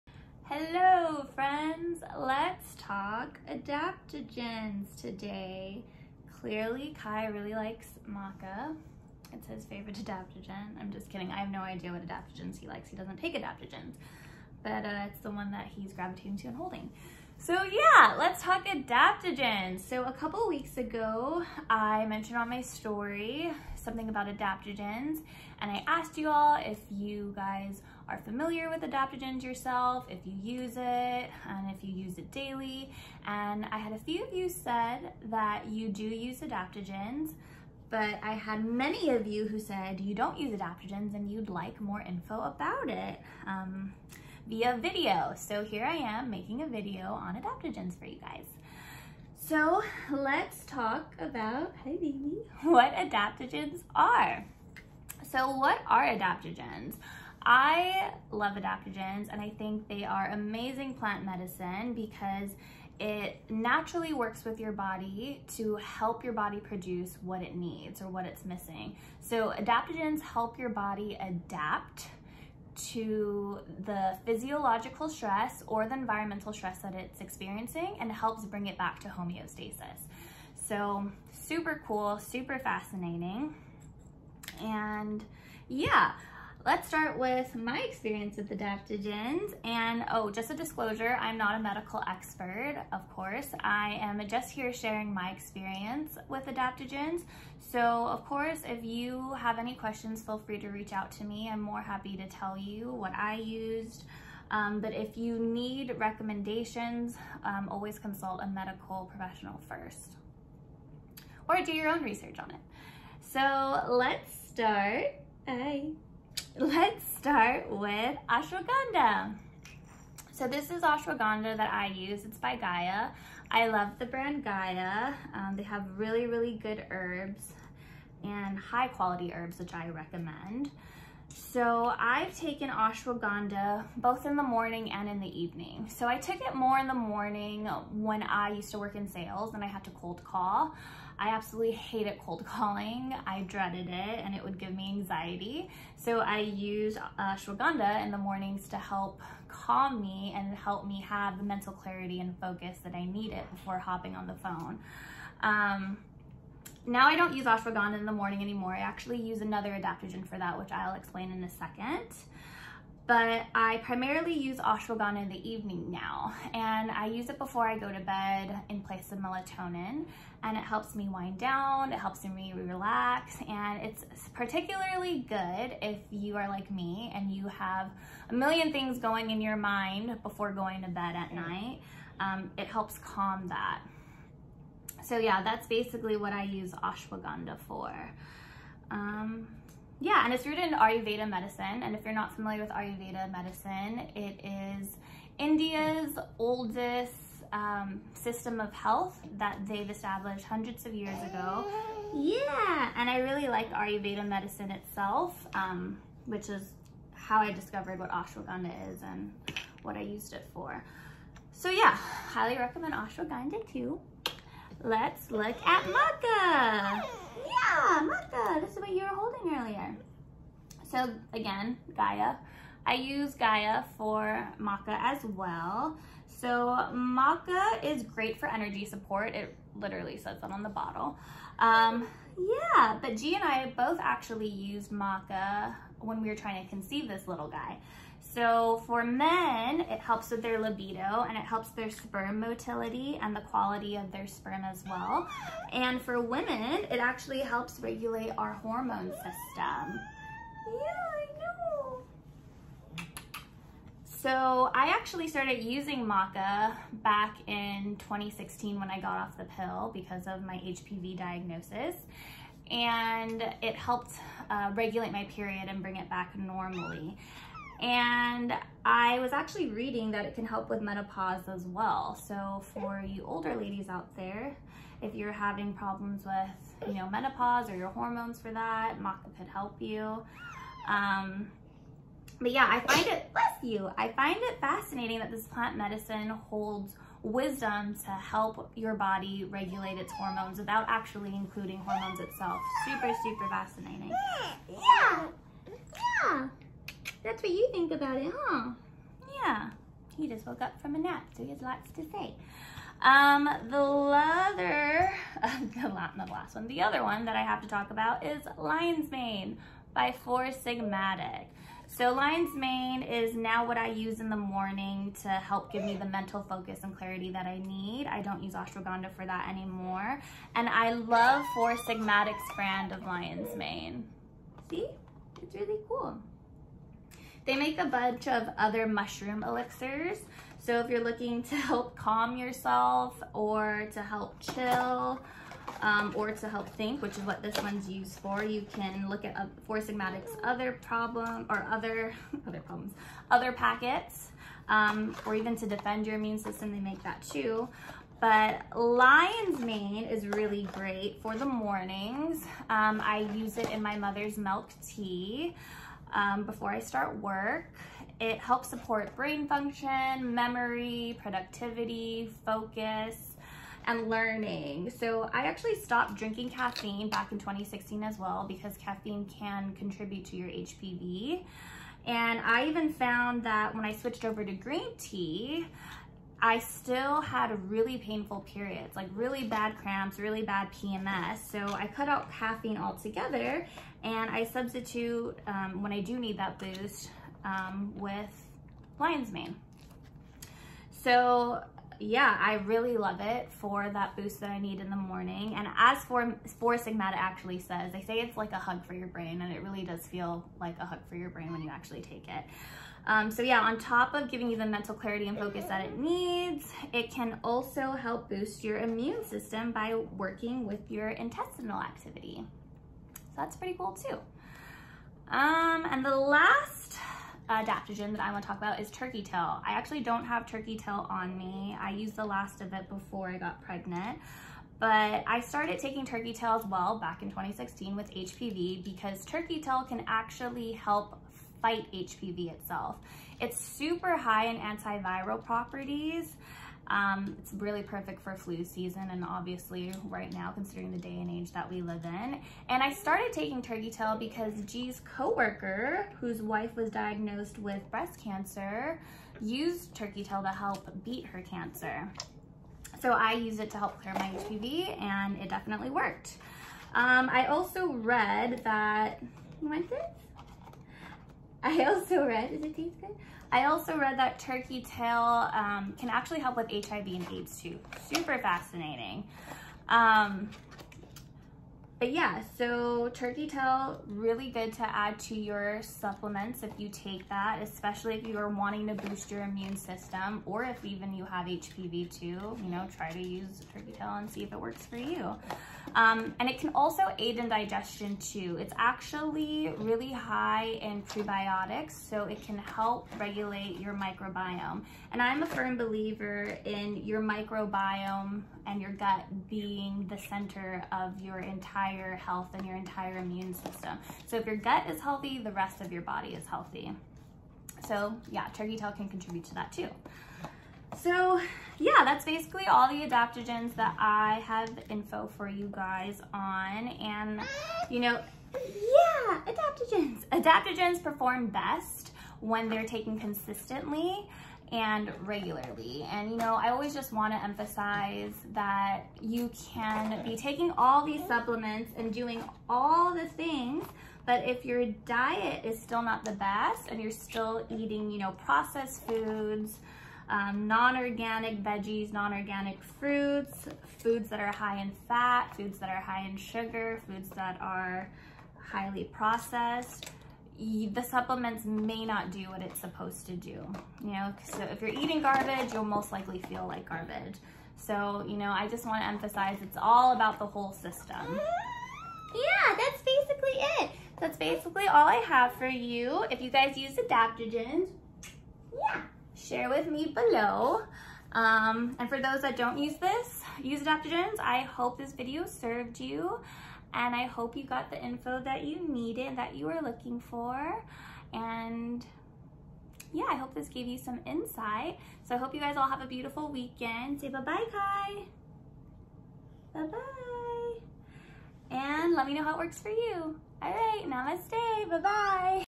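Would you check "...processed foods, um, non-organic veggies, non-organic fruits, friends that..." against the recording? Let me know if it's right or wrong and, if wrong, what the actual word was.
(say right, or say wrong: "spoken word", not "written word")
wrong: "foods", not "friends".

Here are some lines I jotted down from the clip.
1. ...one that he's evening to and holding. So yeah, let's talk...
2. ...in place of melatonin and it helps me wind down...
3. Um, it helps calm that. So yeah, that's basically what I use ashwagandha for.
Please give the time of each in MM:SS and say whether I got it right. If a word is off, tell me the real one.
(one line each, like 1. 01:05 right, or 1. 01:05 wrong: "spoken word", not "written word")
1. 00:15 wrong: "gravitating", not "evening"
2. 02:48 right
3. 03:02 right.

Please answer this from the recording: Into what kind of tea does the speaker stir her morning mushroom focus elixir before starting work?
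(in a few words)
mother's milk tea.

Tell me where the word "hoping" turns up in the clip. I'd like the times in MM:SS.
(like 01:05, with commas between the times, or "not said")
not said.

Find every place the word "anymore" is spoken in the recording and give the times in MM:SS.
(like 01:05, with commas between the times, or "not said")
02:38, 05:19.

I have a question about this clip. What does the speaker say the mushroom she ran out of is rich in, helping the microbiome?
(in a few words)
prebiotics.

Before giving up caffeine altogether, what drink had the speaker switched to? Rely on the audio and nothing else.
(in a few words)
green tea.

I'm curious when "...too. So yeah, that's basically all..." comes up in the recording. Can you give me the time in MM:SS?
08:29.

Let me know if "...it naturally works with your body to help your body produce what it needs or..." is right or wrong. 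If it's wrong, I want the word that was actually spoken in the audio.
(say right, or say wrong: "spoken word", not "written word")
right.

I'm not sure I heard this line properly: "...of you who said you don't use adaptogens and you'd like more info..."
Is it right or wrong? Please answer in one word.
right.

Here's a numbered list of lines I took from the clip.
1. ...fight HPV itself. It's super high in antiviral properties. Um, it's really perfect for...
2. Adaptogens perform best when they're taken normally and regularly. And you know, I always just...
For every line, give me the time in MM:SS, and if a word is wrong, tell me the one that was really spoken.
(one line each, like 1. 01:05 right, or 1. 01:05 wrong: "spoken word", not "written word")
1. 07:11 right
2. 08:40 wrong: "consistently", not "normally".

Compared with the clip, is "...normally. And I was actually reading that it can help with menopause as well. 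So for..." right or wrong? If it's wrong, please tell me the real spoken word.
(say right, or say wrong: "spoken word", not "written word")
right.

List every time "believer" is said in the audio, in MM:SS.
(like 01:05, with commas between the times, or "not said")
08:15.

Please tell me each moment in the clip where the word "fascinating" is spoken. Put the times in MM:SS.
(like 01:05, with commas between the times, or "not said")
01:22, 04:44, 04:53, 07:48.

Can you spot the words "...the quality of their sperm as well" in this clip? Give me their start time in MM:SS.
04:03.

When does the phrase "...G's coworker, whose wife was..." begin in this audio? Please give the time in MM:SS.
07:24.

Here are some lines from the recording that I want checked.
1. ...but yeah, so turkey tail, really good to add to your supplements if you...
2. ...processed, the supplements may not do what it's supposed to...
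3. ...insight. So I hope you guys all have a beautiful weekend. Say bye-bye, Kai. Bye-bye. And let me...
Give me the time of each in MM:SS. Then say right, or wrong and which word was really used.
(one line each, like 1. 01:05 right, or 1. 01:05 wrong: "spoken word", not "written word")
1. 07:52 right
2. 09:09 right
3. 09:44 right.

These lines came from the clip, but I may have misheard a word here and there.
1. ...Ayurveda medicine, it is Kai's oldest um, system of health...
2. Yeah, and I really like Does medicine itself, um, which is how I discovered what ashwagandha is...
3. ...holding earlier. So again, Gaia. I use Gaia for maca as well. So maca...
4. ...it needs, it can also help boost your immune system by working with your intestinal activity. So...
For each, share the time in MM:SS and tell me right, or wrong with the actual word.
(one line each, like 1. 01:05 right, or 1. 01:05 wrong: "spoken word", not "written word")
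1. 03:12 wrong: "India", not "Kai"
2. 03:22 wrong: "Ayurveda", not "Does"
3. 03:39 right
4. 06:45 right.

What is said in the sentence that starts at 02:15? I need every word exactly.
So I took it more in the morning when I used to work in sales and I had to cold call.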